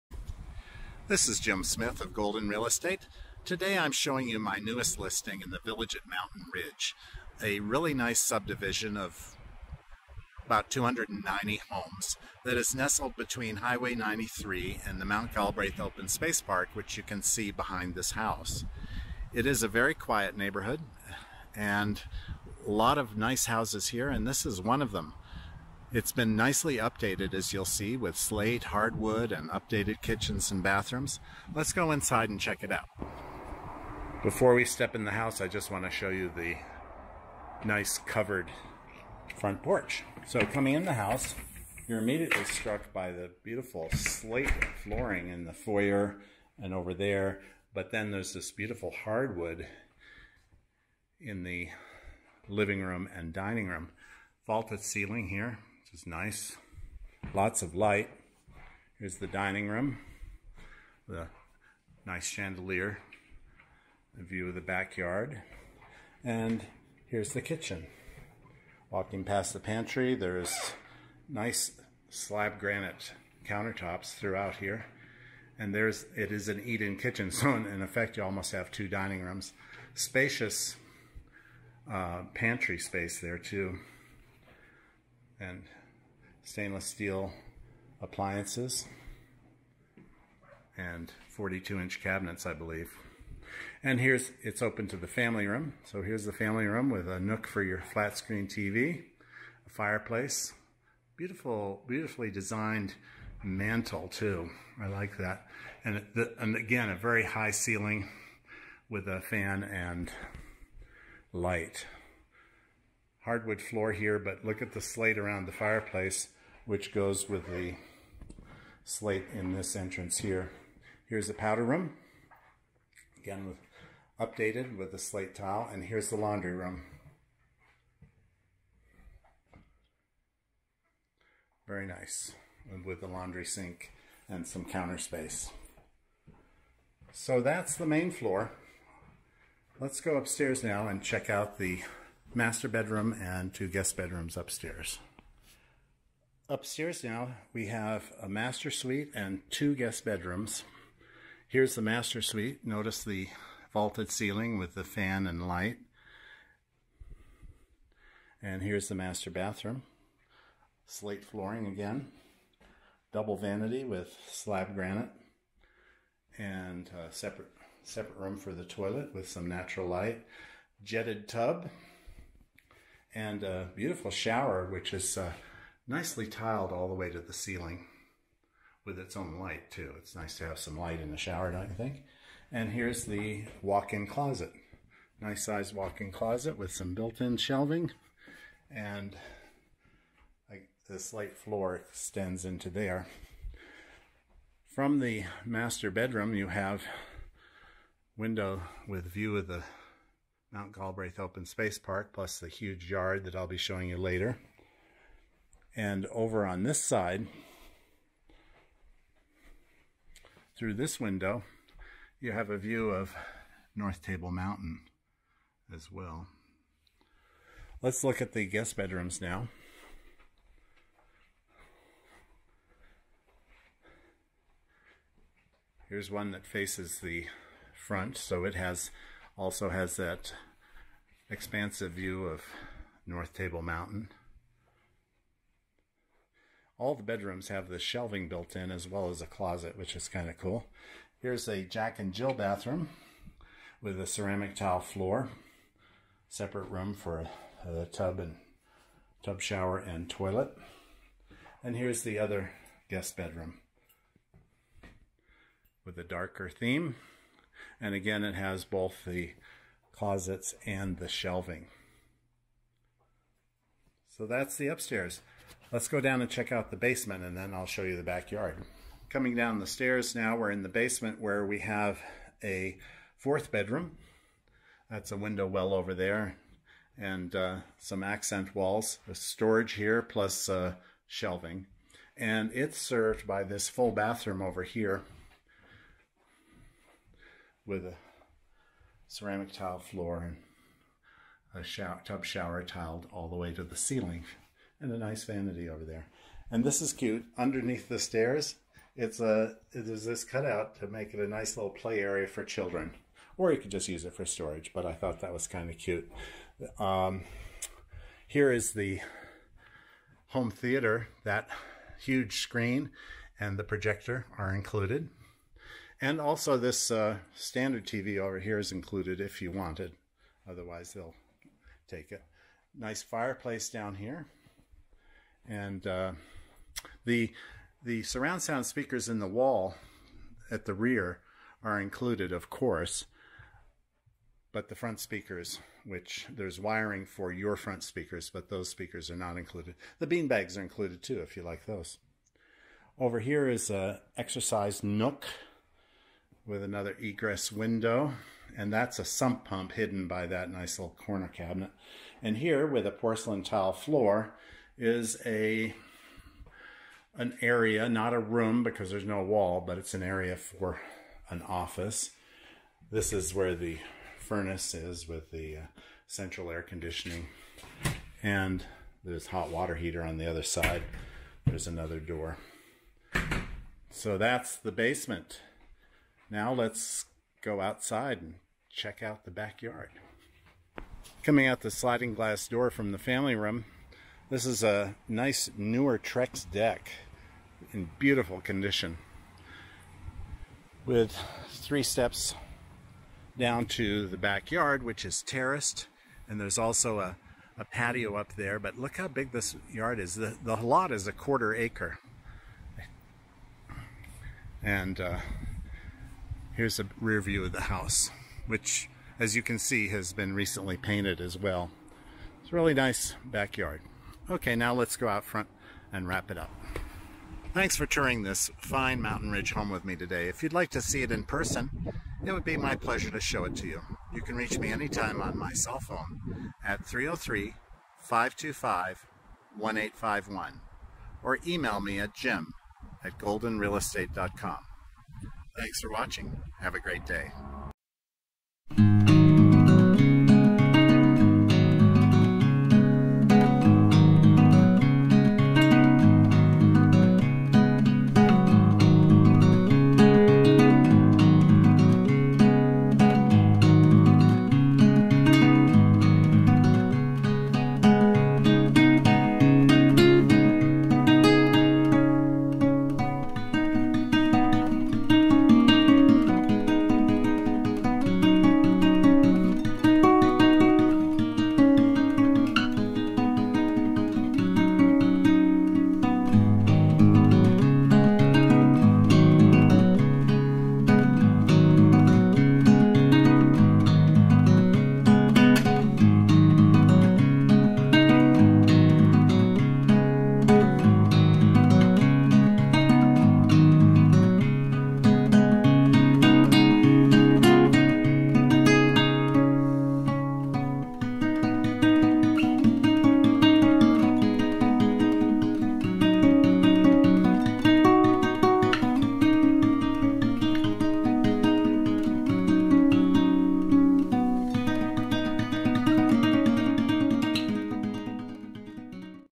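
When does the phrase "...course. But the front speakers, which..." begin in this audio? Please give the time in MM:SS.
05:32.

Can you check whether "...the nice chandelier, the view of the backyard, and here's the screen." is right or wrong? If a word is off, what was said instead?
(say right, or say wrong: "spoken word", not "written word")
wrong: "kitchen", not "screen".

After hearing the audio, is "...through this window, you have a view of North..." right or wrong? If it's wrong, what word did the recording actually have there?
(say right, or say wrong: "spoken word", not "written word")
right.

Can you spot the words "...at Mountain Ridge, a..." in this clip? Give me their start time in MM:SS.
00:05.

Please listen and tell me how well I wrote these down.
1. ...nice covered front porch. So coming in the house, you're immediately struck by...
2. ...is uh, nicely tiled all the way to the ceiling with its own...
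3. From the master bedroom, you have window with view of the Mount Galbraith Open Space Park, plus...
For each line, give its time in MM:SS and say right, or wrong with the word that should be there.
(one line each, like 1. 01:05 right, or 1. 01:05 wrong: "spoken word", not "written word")
1. 00:37 right
2. 02:54 right
3. 03:14 right.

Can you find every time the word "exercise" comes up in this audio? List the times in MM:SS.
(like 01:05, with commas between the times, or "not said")
05:44.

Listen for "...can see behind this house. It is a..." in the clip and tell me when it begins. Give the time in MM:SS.
00:17.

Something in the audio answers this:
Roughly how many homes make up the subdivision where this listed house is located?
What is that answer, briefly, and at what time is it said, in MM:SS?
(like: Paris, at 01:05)
290, at 00:10.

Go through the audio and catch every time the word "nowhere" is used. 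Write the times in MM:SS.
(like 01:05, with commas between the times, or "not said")
not said.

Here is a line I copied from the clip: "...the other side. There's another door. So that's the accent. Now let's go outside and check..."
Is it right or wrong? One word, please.
wrong.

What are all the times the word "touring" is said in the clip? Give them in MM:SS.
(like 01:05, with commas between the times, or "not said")
06:57.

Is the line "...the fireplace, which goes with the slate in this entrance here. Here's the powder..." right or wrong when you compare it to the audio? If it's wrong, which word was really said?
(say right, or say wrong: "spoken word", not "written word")
right.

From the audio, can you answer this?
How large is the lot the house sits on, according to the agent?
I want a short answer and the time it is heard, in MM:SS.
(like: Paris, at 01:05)
a quarter acre, at 06:41.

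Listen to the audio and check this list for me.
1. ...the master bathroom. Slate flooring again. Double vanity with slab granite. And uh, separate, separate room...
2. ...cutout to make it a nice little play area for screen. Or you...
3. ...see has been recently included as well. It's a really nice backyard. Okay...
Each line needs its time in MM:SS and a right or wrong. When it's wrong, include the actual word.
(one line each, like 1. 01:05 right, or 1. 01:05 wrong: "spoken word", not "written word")
1. 02:38 right
2. 05:00 wrong: "children", not "screen"
3. 06:49 wrong: "painted", not "included".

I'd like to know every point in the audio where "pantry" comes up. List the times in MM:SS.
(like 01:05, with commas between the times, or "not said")
01:09, 01:22.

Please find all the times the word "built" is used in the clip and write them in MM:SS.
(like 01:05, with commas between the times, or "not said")
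03:06, 03:58.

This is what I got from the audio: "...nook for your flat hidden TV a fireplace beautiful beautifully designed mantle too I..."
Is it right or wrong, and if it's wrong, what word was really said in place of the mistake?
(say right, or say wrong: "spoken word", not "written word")
wrong: "screen", not "hidden".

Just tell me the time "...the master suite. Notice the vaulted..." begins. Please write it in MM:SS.
02:31.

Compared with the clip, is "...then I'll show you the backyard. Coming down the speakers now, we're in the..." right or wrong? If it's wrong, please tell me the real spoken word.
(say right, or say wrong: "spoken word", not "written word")
wrong: "stairs", not "speakers".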